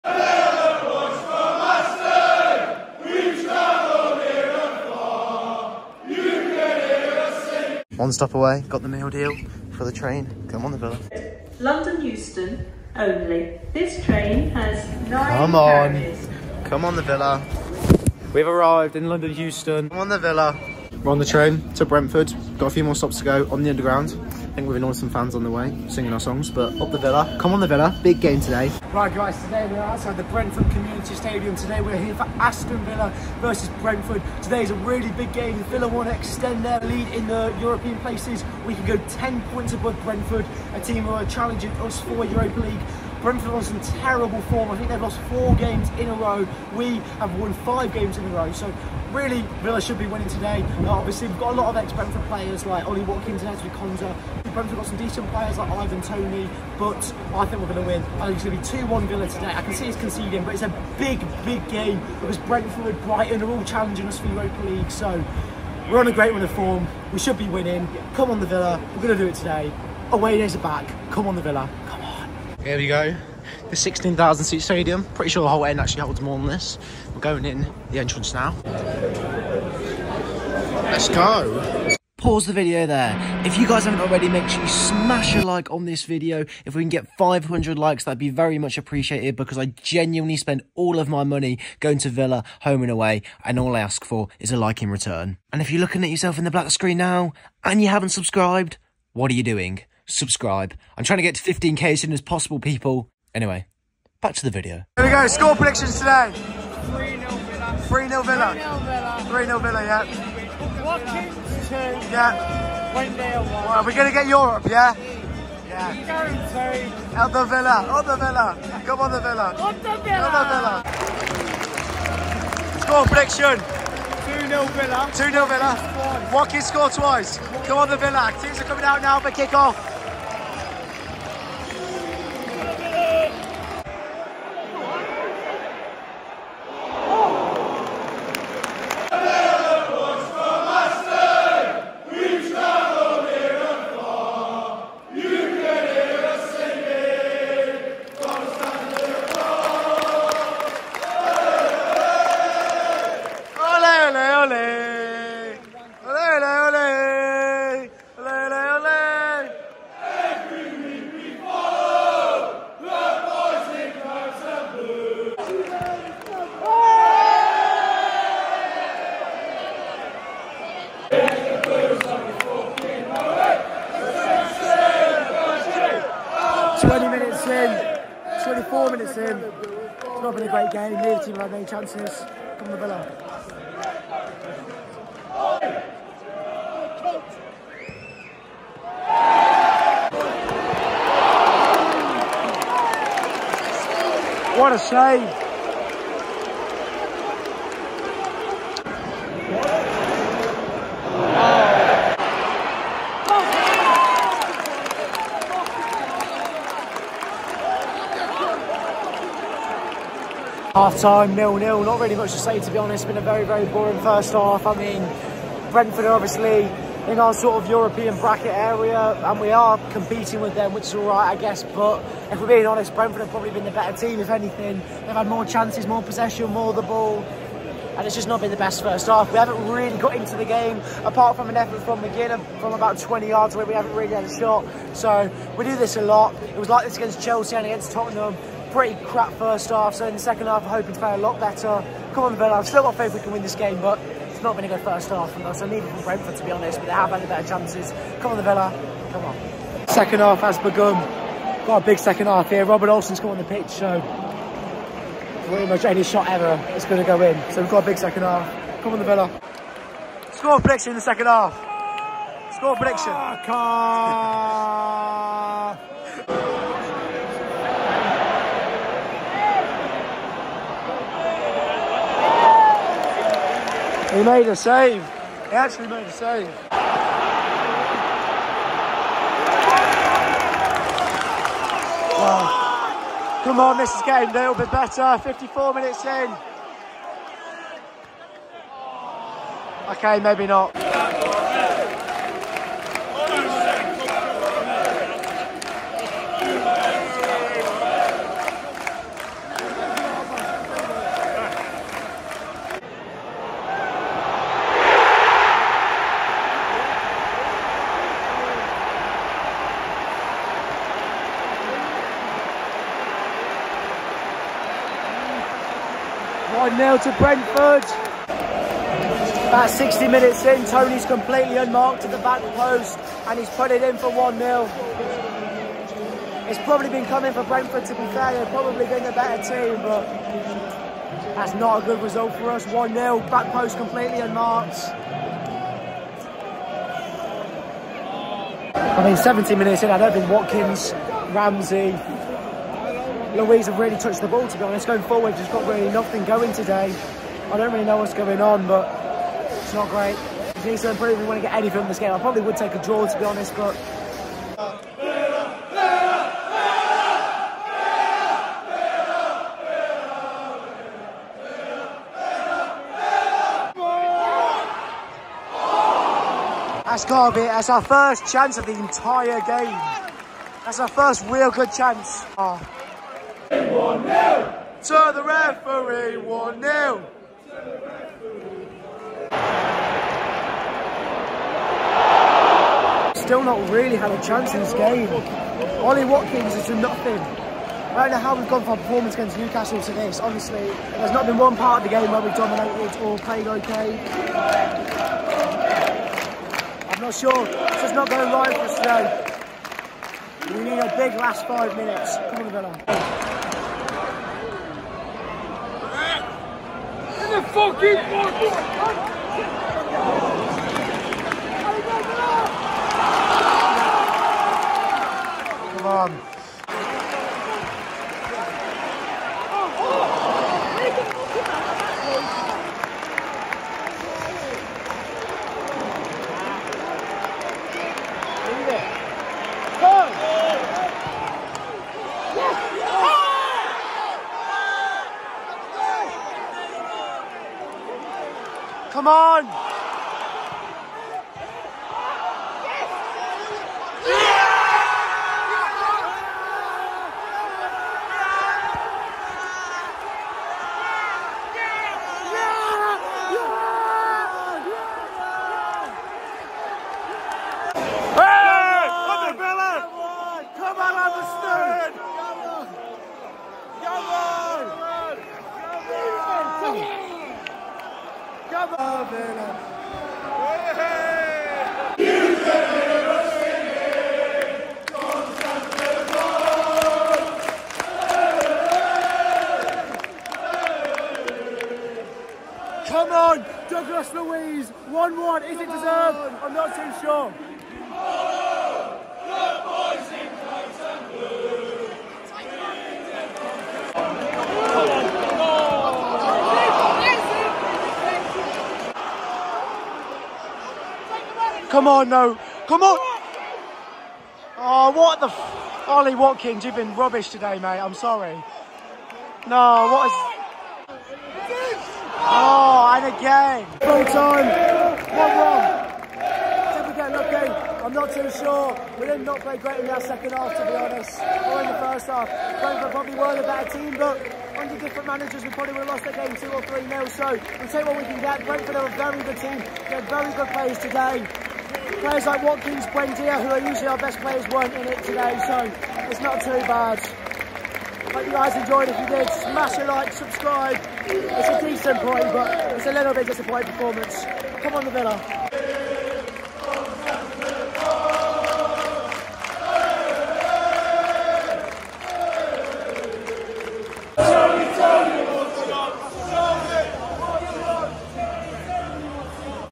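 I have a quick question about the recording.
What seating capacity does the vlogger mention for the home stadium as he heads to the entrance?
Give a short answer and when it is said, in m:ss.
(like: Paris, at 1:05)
16,000, at 1:13.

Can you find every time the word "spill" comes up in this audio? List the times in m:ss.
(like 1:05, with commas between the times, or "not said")
not said.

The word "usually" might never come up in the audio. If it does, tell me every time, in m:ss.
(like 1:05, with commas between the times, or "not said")
8:53.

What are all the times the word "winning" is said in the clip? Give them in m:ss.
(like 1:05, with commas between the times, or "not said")
0:50, 1:07.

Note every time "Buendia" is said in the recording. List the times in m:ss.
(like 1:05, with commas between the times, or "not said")
8:52.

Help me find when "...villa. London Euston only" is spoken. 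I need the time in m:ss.
0:10.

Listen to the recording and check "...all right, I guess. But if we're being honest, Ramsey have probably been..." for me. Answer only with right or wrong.
wrong.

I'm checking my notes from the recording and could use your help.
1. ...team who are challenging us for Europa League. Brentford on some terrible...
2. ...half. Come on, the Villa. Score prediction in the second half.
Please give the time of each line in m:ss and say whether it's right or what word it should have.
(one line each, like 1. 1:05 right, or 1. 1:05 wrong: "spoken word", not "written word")
1. 0:40 right
2. 4:18 right.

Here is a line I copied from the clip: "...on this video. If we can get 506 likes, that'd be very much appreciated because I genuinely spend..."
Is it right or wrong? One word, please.
wrong.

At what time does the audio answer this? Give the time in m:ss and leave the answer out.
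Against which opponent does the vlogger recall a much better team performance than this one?
6:29.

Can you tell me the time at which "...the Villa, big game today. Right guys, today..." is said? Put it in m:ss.
0:27.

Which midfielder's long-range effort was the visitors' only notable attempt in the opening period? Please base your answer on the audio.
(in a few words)
McGinn.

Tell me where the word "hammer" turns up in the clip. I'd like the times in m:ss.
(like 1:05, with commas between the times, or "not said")
not said.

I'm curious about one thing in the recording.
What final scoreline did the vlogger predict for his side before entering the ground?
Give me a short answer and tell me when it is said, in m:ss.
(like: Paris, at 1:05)
2-1 Villa, at 0:59.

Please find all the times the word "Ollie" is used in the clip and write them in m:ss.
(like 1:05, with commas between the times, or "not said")
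0:52, 6:25, 8:25.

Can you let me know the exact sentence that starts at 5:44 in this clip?
Going forward, just got really nothing going today.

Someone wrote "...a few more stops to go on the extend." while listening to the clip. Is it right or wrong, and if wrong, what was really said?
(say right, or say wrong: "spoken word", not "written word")
wrong: "underground", not "extend".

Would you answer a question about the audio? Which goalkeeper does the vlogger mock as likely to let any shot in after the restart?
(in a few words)
Robin Olsen.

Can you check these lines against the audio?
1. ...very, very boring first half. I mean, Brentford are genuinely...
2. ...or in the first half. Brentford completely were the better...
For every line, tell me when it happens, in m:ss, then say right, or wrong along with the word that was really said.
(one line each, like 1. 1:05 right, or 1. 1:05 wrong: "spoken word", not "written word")
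1. 3:33 wrong: "obviously", not "genuinely"
2. 8:41 wrong: "probably", not "completely".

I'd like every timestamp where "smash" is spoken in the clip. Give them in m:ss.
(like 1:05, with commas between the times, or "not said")
1:24, 8:59.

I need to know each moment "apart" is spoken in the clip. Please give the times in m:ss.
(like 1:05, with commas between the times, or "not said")
3:51.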